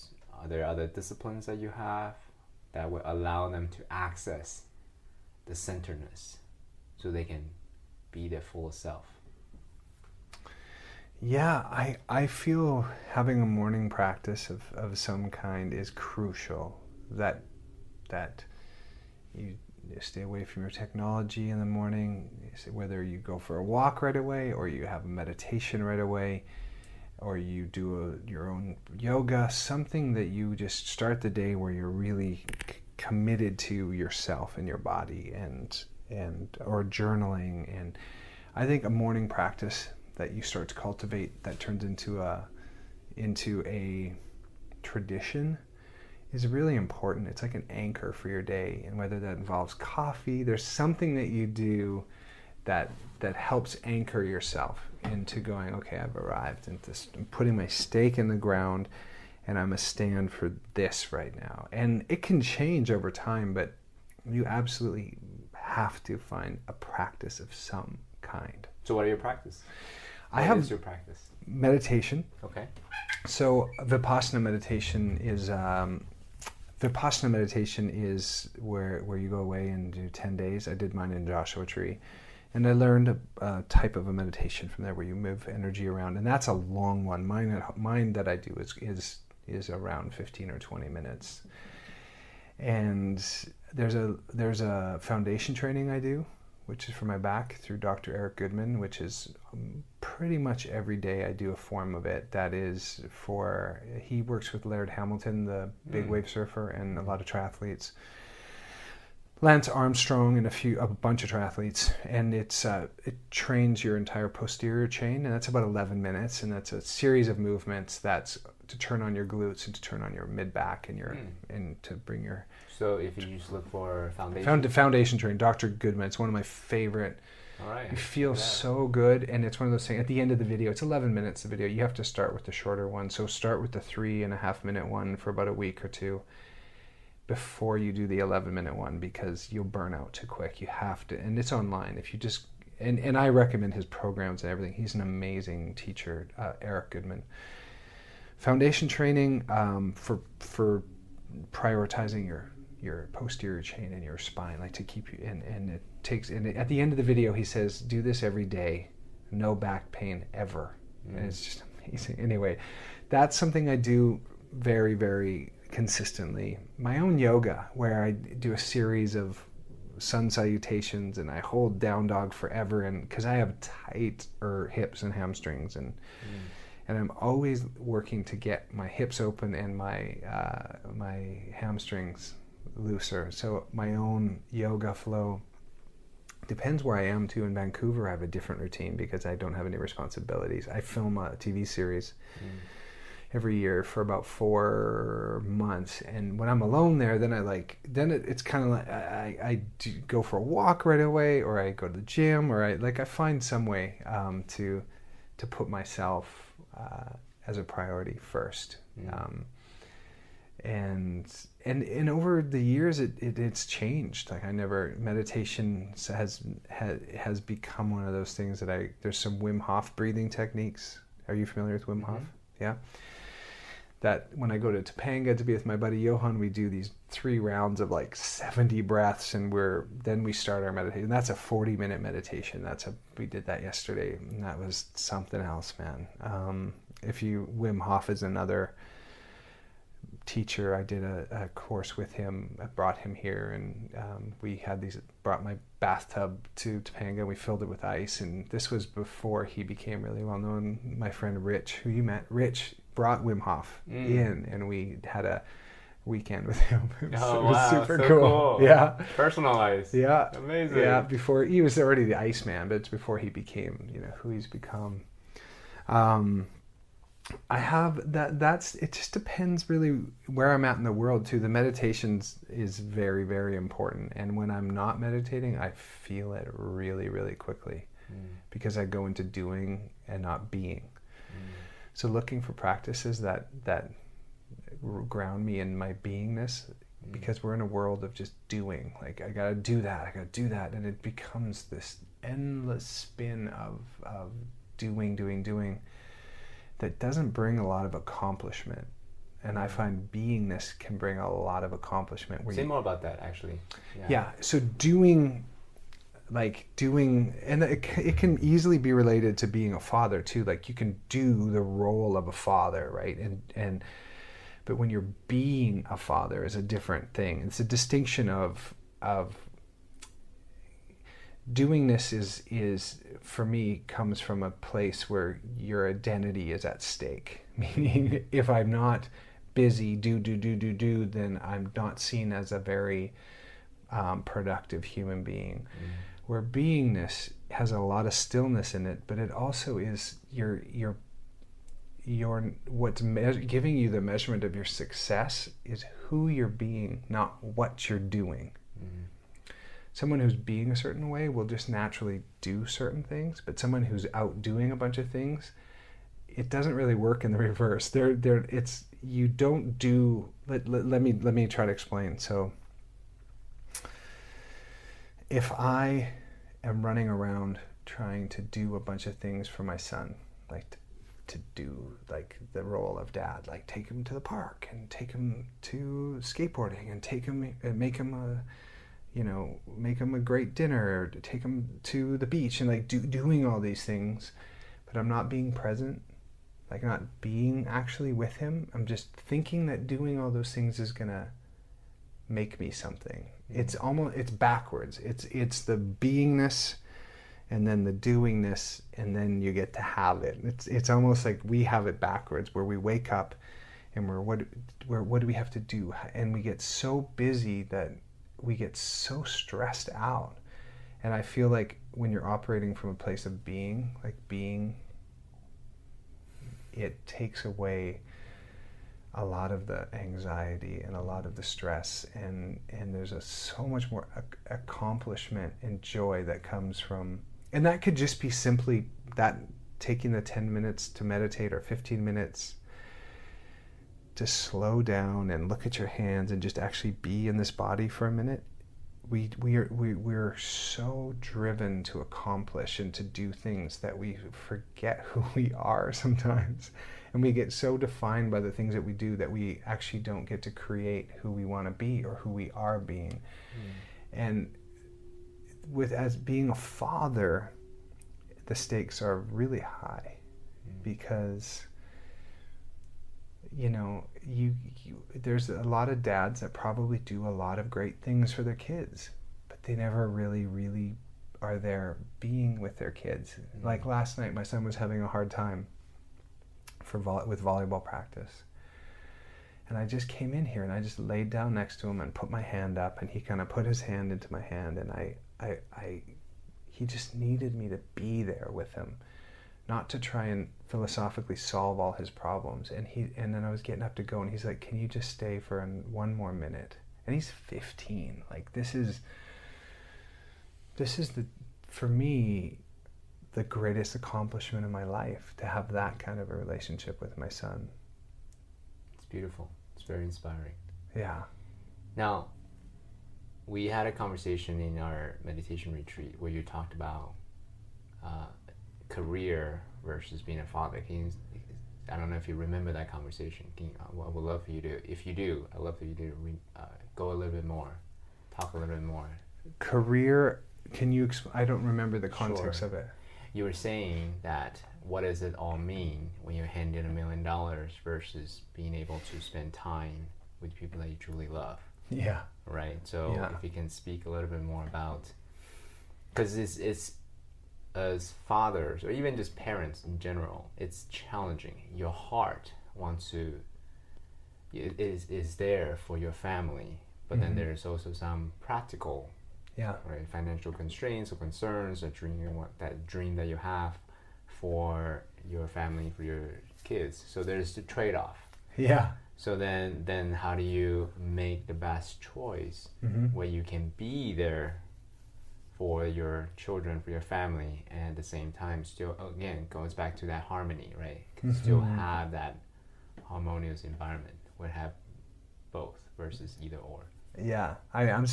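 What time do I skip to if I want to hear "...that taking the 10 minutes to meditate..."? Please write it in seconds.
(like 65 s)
429 s.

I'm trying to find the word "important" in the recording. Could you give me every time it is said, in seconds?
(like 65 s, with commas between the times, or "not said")
46 s, 273 s.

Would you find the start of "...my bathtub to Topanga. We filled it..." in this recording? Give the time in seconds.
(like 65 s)
245 s.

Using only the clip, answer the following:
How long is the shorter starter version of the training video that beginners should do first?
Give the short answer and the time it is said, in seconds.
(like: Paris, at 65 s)
3.5 minutes, at 133 s.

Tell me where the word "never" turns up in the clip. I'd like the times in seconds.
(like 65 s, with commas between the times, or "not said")
214 s, 469 s.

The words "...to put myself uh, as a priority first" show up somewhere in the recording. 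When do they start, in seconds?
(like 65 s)
205 s.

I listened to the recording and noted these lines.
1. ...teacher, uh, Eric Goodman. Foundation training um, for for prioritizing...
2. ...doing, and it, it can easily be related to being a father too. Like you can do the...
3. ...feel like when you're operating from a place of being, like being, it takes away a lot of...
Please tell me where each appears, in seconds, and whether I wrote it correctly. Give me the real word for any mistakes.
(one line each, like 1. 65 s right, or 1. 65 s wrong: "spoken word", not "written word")
1. 145 s right
2. 306 s right
3. 411 s right.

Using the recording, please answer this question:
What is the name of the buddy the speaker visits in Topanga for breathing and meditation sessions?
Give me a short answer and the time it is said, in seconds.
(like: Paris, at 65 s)
Johan, at 225 s.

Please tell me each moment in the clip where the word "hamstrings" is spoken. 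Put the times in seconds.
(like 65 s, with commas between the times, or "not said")
175 s, 181 s.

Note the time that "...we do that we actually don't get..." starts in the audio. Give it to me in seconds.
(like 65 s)
448 s.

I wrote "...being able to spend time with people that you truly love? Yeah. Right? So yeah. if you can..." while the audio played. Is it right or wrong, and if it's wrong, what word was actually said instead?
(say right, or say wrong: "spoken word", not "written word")
right.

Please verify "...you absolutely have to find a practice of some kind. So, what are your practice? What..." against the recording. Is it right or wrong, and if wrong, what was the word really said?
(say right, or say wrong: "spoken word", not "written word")
right.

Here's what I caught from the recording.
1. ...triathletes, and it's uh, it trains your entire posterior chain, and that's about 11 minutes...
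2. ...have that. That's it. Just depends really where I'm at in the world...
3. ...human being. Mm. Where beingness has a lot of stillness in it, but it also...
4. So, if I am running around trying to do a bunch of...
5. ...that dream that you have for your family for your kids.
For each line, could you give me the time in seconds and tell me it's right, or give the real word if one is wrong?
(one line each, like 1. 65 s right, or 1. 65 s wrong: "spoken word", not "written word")
1. 111 s right
2. 267 s right
3. 334 s right
4. 362 s right
5. 562 s right.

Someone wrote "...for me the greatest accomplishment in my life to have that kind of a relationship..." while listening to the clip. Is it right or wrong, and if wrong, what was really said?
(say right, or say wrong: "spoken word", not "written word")
right.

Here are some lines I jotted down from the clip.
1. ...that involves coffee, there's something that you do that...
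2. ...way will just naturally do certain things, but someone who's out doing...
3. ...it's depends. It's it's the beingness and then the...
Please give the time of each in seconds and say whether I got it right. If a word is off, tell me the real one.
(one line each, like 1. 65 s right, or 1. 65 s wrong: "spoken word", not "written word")
1. 49 s right
2. 351 s right
3. 394 s wrong: "backwards", not "depends".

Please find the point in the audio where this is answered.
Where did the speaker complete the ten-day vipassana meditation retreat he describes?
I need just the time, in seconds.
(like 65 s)
81 s.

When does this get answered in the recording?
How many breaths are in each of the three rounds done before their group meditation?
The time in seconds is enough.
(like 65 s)
228 s.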